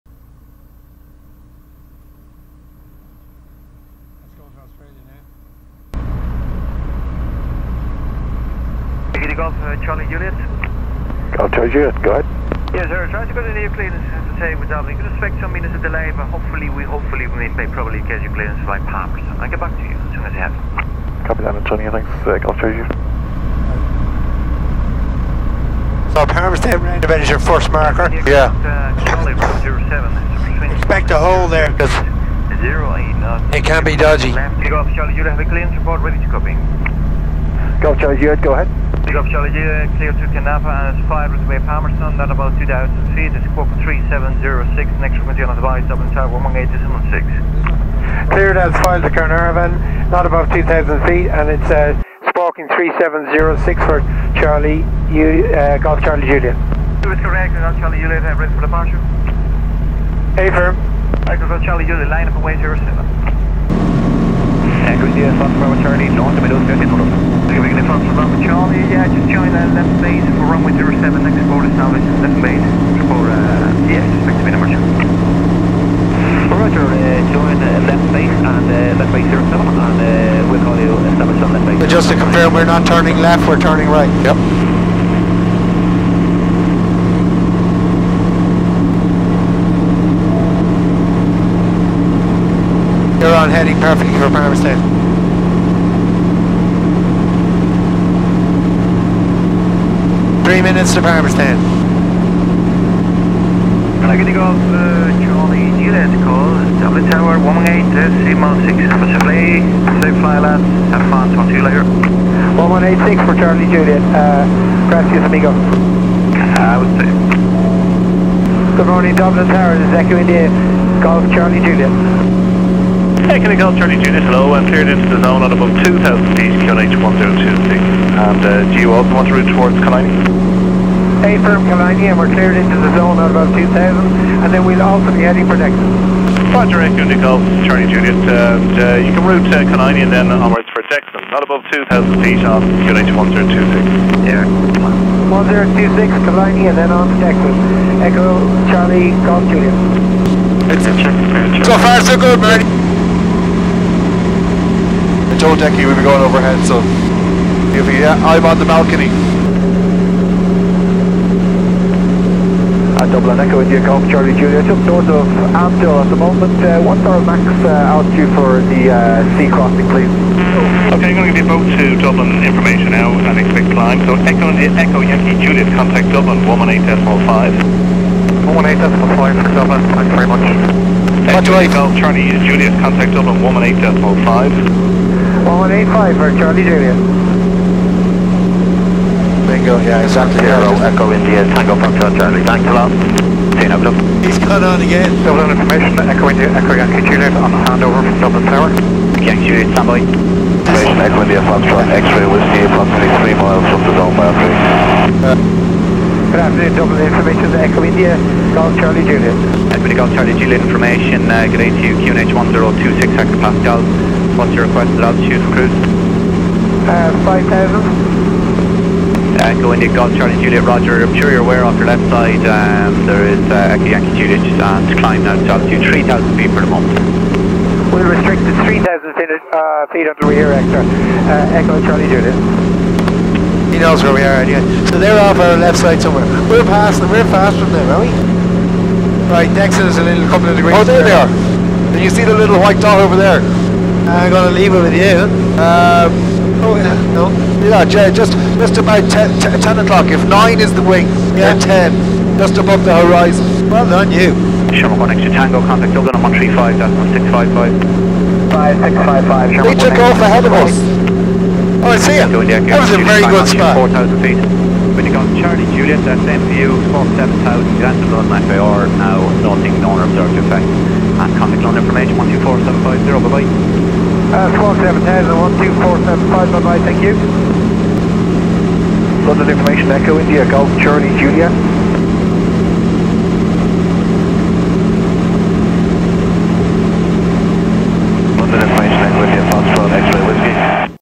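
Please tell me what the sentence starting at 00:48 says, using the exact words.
Cleared as files to Caernarfon, not above 2,000 feet, and it's uh, 3706 for Charlie, U, uh, Golf Charlie Julia.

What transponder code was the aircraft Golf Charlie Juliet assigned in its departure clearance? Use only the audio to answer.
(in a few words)
3706.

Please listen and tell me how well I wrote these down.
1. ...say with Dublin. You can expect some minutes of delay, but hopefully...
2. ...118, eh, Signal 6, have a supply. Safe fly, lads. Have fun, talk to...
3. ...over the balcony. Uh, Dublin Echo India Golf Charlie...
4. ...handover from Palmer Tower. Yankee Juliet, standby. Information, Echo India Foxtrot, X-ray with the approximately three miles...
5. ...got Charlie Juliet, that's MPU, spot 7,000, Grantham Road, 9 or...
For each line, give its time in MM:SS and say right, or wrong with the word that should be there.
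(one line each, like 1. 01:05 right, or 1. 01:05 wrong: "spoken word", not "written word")
1. 00:14 right
2. 01:47 right
3. 02:38 right
4. 03:17 wrong: "Dublin", not "Palmer"
5. 04:25 right.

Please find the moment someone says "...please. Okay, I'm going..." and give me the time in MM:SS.
02:49.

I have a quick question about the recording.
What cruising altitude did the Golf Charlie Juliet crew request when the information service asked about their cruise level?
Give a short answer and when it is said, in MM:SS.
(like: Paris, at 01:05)
5,000 feet, at 03:37.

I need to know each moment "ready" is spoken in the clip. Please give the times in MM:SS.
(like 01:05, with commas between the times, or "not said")
00:36, 00:58.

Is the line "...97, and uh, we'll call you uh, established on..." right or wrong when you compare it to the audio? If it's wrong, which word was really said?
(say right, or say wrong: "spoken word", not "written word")
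wrong: "07", not "97".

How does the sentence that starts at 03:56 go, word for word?
We're past them, we're past from them, are we?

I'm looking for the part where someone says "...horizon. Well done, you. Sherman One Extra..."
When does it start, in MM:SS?
04:12.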